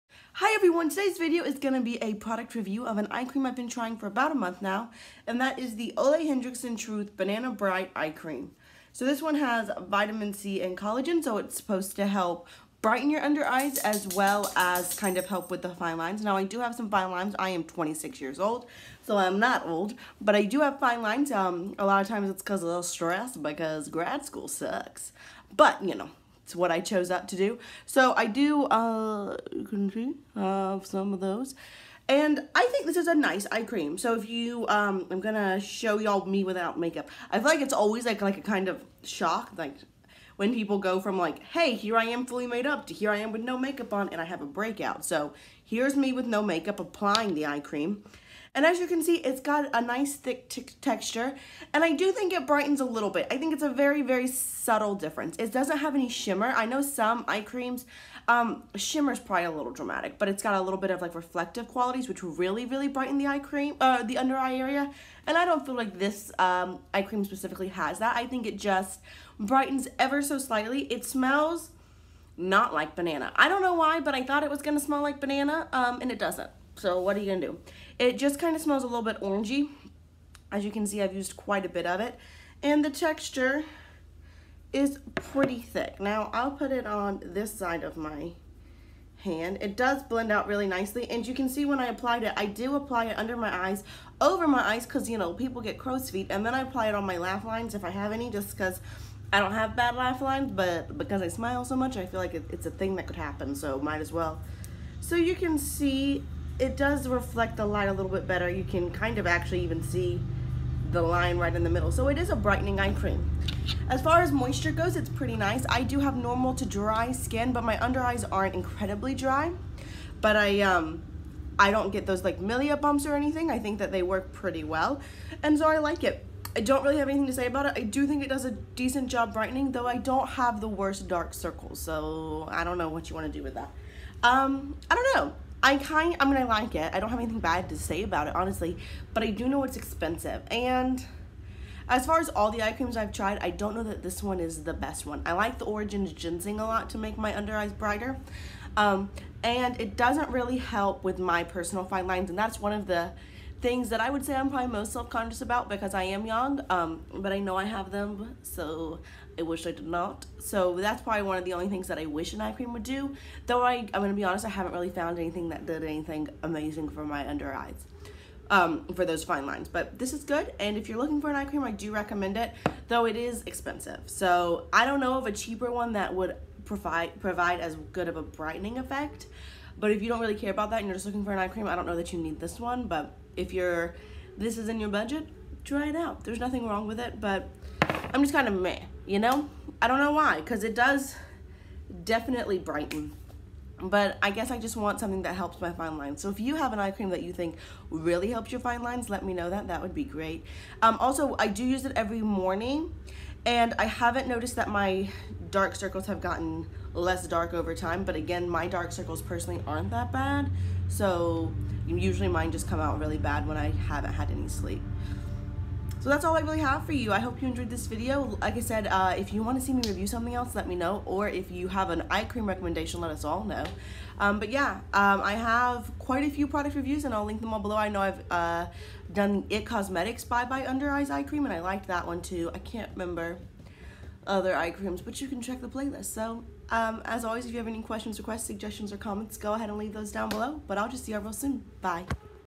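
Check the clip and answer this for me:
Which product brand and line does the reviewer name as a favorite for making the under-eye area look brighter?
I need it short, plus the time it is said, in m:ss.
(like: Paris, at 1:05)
Origins Ginseng, at 2:25.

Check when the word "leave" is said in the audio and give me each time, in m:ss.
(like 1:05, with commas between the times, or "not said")
3:59.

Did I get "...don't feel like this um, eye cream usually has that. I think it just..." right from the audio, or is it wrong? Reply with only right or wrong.
wrong.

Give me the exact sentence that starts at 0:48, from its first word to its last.
And as you can see, it's got a nice thick texture.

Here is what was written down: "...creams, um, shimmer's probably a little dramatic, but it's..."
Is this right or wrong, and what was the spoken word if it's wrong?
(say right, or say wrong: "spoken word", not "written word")
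right.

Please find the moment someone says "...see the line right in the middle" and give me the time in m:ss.
1:49.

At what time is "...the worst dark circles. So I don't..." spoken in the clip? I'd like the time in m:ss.
2:10.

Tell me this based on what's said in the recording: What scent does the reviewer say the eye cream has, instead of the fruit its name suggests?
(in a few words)
orangey.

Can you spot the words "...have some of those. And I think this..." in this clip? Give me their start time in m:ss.
0:30.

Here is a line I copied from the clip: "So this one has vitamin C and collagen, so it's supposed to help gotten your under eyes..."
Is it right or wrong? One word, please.
wrong.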